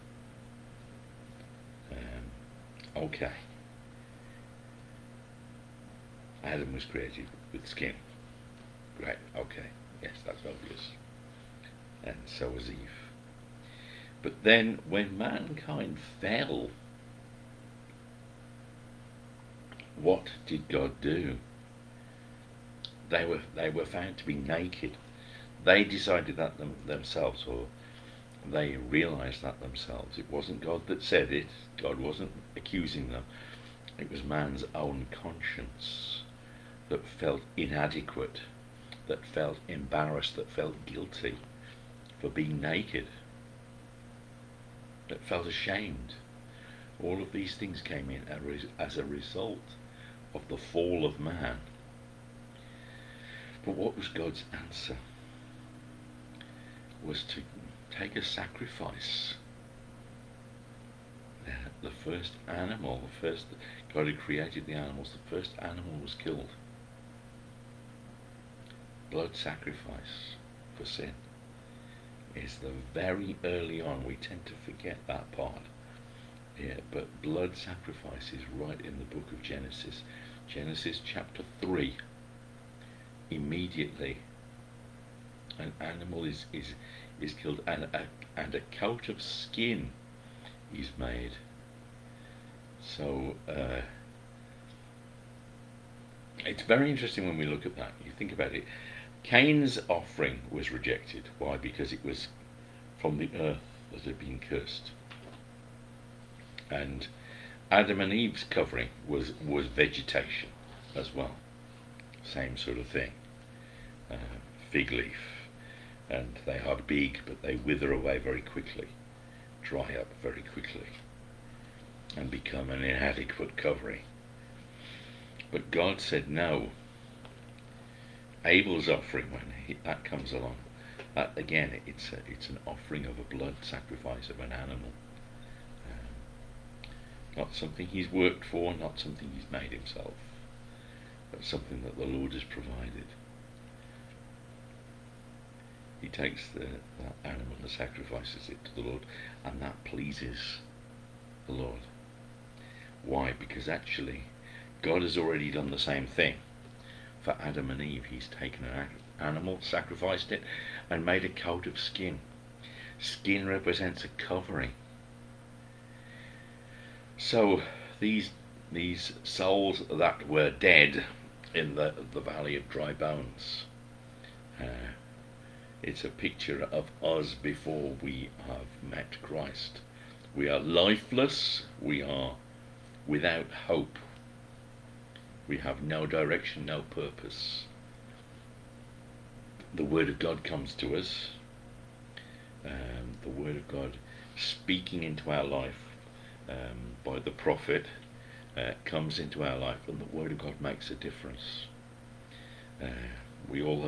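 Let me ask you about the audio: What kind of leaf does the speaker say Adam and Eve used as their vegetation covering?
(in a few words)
Fig leaf.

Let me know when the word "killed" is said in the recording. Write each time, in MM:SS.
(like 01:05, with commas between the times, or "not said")
01:06, 01:27.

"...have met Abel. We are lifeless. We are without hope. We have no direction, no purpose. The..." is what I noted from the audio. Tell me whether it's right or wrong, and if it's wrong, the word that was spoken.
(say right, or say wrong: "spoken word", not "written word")
wrong: "Christ", not "Abel".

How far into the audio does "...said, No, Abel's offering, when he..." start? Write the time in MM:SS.
02:06.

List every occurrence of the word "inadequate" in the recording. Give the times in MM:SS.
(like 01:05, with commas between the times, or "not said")
00:37, 02:02.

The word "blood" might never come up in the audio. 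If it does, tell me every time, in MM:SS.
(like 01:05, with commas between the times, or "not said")
01:09, 01:17, 02:13.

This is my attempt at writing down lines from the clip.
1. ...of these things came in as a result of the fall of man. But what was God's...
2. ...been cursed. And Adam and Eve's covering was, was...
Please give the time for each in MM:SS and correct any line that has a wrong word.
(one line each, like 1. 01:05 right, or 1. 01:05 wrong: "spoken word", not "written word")
1. 00:47 right
2. 01:44 right.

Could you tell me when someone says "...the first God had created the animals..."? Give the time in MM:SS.
01:03.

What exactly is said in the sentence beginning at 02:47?
So these these souls that were dead in the the valley of dry bones.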